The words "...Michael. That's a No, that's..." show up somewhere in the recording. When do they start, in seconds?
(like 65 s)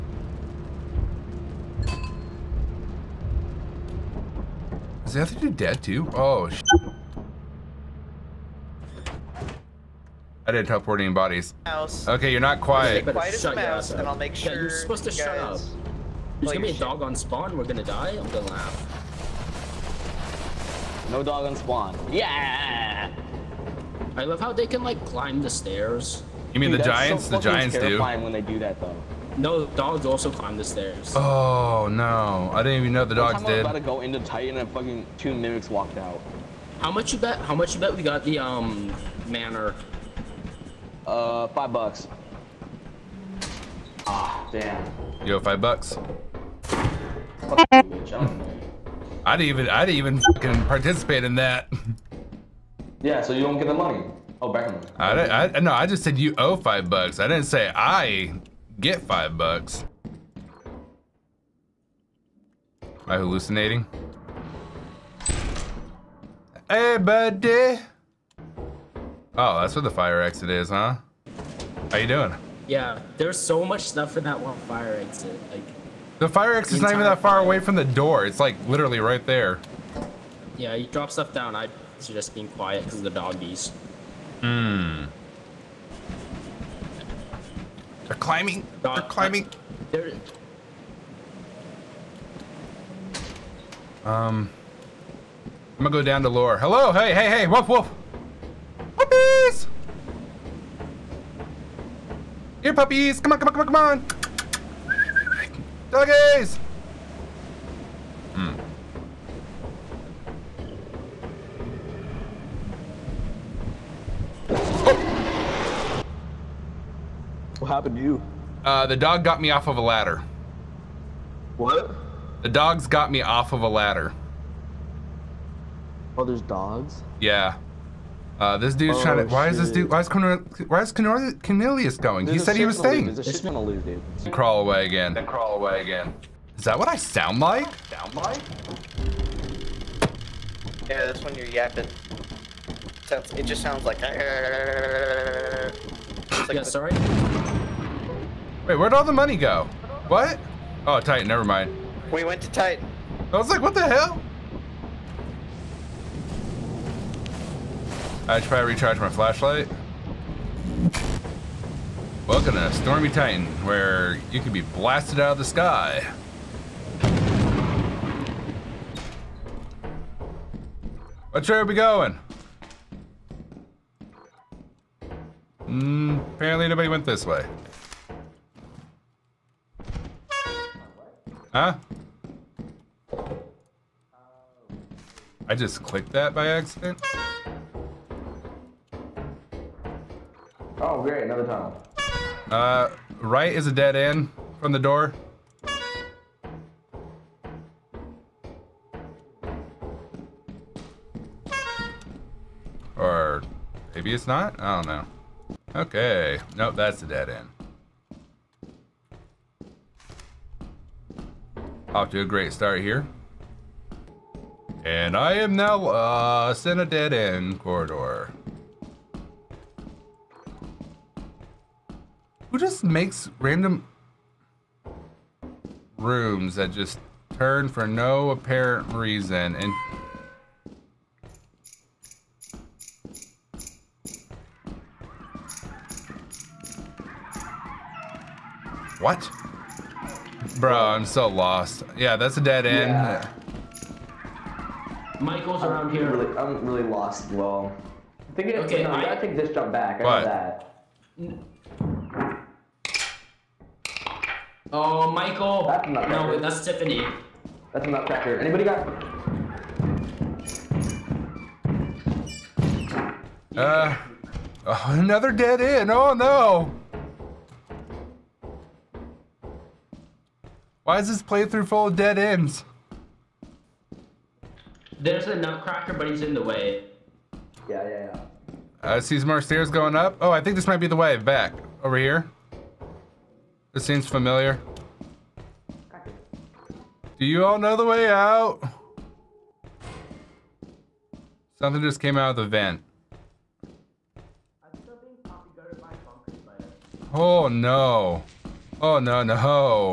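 255 s.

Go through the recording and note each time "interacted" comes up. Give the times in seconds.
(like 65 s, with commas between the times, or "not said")
not said.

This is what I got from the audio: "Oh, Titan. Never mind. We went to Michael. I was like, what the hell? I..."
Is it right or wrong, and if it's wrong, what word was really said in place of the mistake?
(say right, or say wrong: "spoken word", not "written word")
wrong: "Titan", not "Michael".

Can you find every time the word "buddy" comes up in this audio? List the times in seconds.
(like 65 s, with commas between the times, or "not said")
66 s.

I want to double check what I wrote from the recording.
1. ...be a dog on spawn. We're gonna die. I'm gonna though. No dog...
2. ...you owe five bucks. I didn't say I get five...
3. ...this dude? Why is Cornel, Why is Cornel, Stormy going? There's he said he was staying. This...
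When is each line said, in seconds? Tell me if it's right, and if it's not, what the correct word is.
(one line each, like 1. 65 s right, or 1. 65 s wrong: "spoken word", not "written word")
1. 16 s wrong: "laugh", not "though"
2. 56 s right
3. 129 s wrong: "Cornelius", not "Stormy".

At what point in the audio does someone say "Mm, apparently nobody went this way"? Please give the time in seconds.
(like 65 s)
175 s.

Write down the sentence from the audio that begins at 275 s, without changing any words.
There's a nutcracker, but he's in the way.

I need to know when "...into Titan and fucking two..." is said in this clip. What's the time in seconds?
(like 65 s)
34 s.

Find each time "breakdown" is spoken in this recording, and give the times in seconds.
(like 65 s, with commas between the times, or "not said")
not said.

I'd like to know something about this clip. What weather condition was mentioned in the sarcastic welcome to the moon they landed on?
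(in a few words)
Stormy.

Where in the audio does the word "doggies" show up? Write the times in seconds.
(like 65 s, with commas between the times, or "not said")
83 s, 105 s.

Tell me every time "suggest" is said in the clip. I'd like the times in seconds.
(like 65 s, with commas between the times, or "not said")
82 s.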